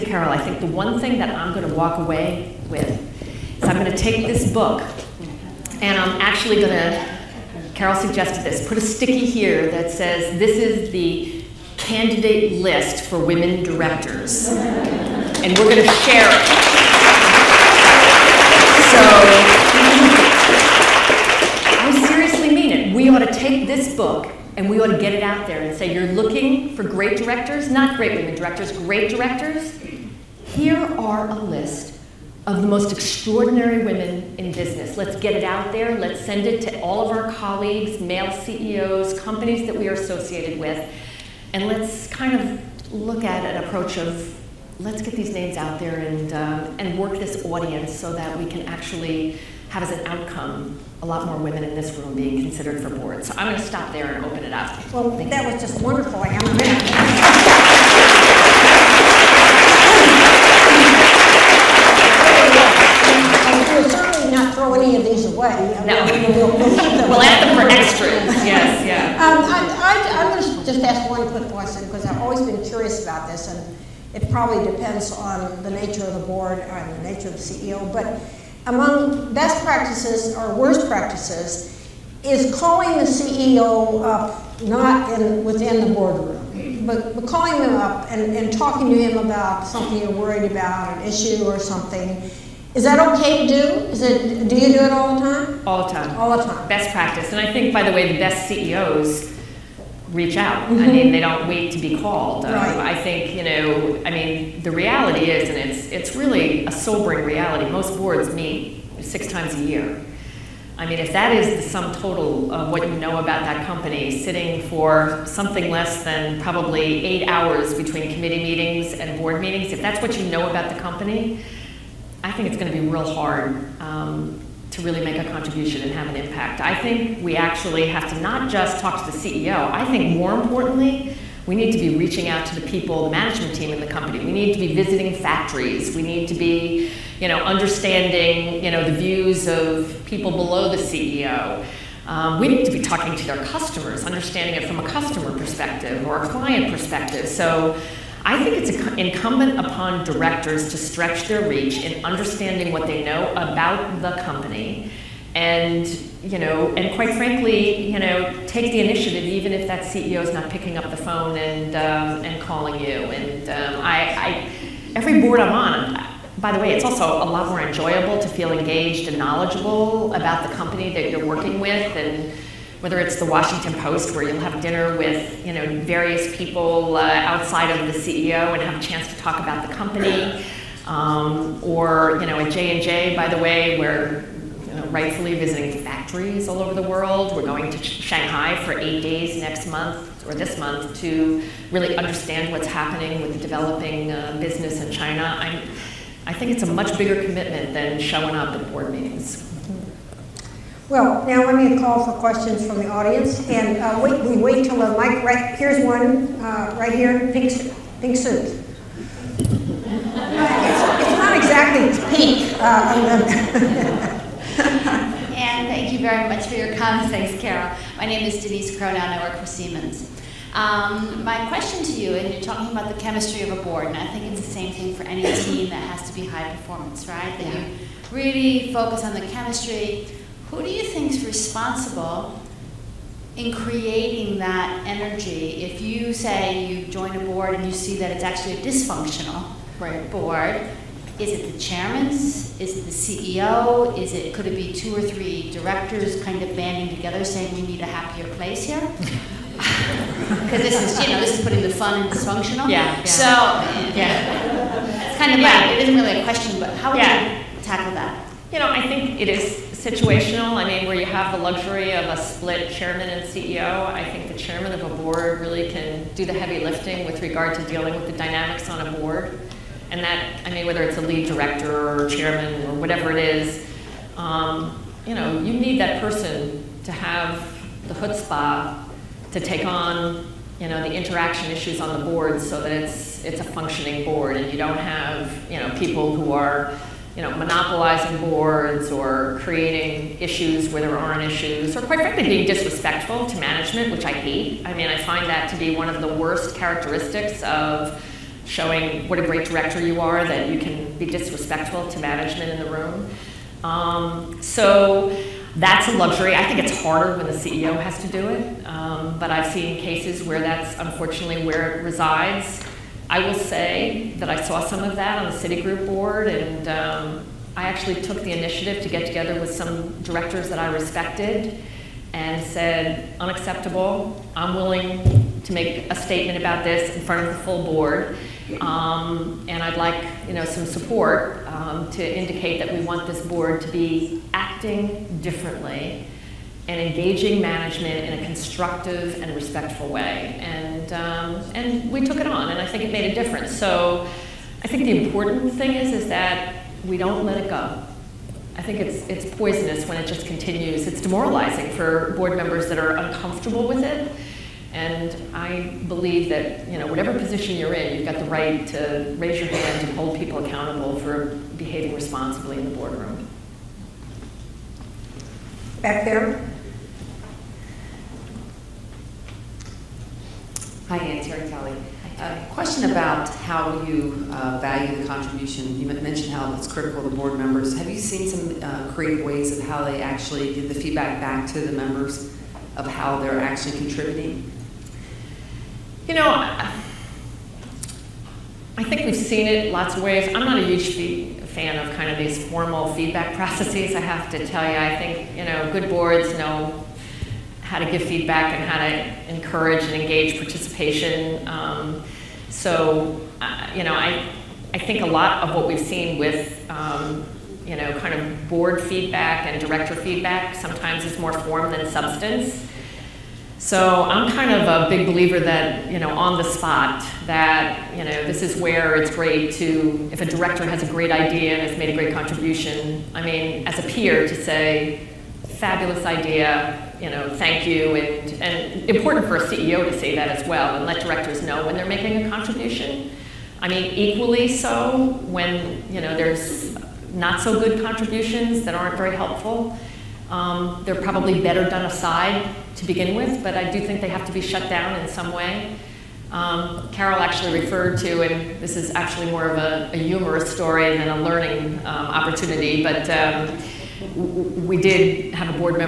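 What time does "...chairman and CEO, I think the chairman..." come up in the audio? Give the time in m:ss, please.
4:22.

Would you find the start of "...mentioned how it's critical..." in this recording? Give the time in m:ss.
6:15.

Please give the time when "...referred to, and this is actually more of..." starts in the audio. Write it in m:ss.
7:27.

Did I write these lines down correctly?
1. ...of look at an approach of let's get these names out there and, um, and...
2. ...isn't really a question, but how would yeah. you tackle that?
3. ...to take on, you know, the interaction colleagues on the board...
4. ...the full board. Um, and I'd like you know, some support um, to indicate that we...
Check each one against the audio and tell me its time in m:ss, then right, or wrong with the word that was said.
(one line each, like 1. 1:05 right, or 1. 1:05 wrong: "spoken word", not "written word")
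1. 0:42 right
2. 4:15 right
3. 4:39 wrong: "issues", not "colleagues"
4. 5:27 right.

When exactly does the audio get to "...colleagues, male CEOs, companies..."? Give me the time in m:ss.
0:37.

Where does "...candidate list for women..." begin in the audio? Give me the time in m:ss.
0:11.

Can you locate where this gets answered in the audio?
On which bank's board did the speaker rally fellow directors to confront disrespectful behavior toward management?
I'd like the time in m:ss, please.
5:15.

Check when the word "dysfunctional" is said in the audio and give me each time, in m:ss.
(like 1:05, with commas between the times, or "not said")
3:58, 4:12.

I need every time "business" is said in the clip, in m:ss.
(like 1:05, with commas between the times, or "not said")
0:34, 3:14.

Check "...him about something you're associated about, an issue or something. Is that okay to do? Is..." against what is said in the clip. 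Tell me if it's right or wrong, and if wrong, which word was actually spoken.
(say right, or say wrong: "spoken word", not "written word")
wrong: "worried", not "associated".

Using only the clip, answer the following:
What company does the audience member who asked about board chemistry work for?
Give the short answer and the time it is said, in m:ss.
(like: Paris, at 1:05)
Siemens, at 3:39.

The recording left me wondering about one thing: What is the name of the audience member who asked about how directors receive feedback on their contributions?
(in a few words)
Terry Kelly.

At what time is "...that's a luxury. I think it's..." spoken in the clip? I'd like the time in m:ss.
5:05.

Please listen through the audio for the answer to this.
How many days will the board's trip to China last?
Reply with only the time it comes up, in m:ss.
3:08.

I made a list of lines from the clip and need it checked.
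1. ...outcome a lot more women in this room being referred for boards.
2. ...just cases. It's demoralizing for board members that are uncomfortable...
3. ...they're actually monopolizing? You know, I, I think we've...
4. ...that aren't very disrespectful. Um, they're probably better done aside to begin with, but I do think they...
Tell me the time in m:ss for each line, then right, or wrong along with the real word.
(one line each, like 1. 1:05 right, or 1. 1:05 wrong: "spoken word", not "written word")
1. 0:50 wrong: "considered", not "referred"
2. 5:50 wrong: "continues", not "cases"
3. 6:23 wrong: "contributing", not "monopolizing"
4. 7:18 wrong: "helpful", not "disrespectful".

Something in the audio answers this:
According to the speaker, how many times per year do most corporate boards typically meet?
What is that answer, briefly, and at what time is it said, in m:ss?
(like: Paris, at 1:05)
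6, at 1:49.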